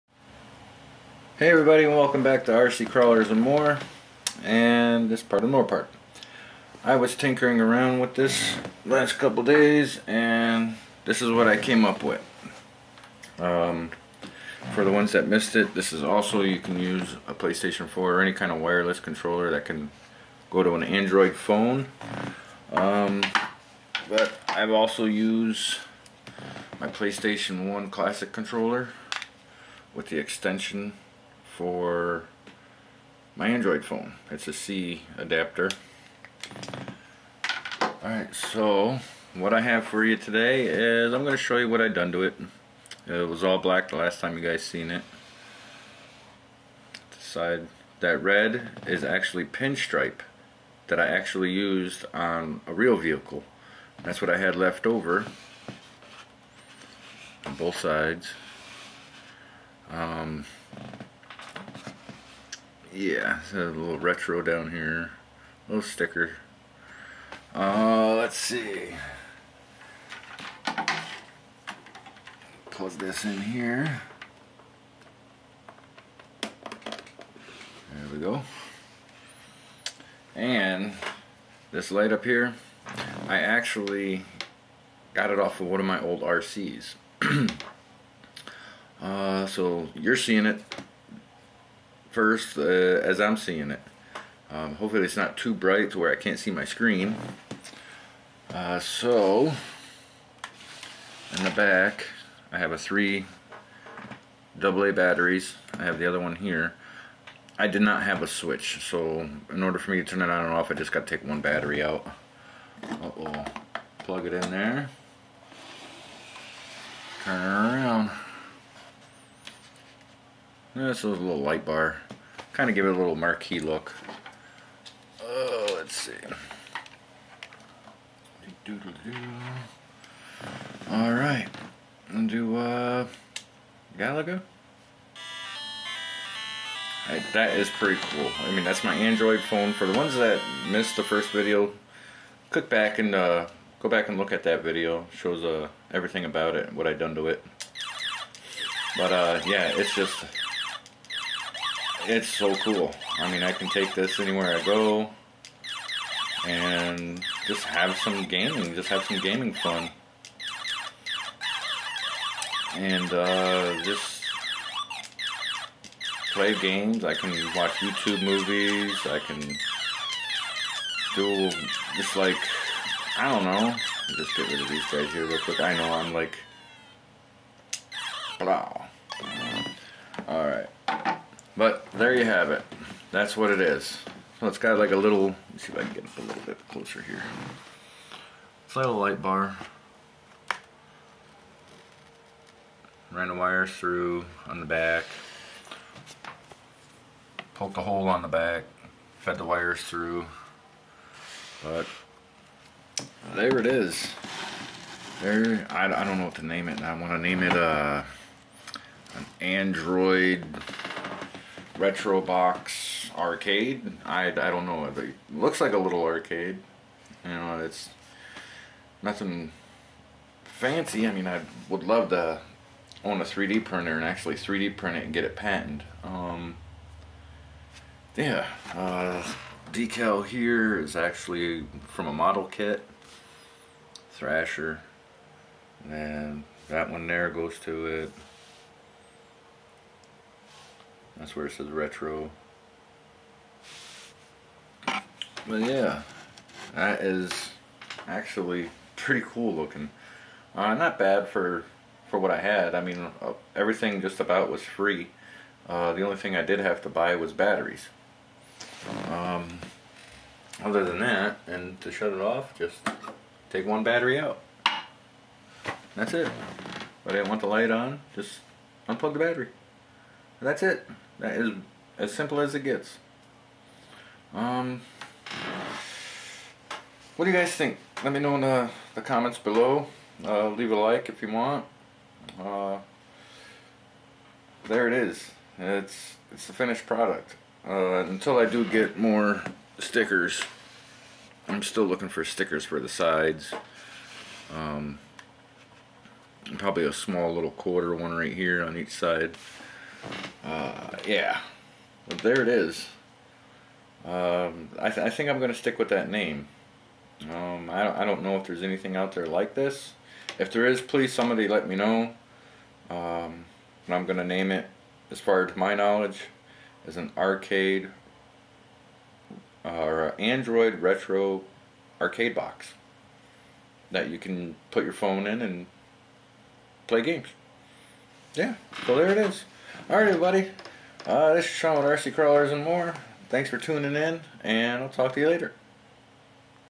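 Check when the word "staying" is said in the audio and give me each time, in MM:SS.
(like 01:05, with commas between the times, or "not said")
not said.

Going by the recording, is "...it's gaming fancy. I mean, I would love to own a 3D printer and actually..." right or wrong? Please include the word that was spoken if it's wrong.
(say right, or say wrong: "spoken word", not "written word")
wrong: "nothing", not "gaming".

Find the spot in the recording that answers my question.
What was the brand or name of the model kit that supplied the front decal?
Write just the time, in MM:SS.
03:54.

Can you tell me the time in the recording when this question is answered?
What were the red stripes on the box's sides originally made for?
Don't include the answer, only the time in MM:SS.
00:52.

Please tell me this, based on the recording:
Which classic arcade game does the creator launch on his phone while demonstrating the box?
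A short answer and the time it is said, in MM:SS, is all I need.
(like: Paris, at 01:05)
Galaga, at 02:13.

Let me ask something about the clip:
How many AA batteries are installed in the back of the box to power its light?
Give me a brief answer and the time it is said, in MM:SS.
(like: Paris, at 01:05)
3, at 01:42.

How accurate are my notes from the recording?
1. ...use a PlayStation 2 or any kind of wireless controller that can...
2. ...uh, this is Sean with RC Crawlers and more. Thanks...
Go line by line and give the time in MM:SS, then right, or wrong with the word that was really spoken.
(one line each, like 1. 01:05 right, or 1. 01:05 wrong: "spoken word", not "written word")
1. 00:16 wrong: "4", not "2"
2. 05:31 right.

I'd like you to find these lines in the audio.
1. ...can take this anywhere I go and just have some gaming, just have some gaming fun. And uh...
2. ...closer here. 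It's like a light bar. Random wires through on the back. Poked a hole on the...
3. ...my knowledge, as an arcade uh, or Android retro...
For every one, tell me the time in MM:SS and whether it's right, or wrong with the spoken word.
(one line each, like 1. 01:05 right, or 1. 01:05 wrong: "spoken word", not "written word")
1. 02:33 right
2. 03:06 right
3. 05:15 right.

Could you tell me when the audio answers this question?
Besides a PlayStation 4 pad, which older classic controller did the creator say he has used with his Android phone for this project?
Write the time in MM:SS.
00:26.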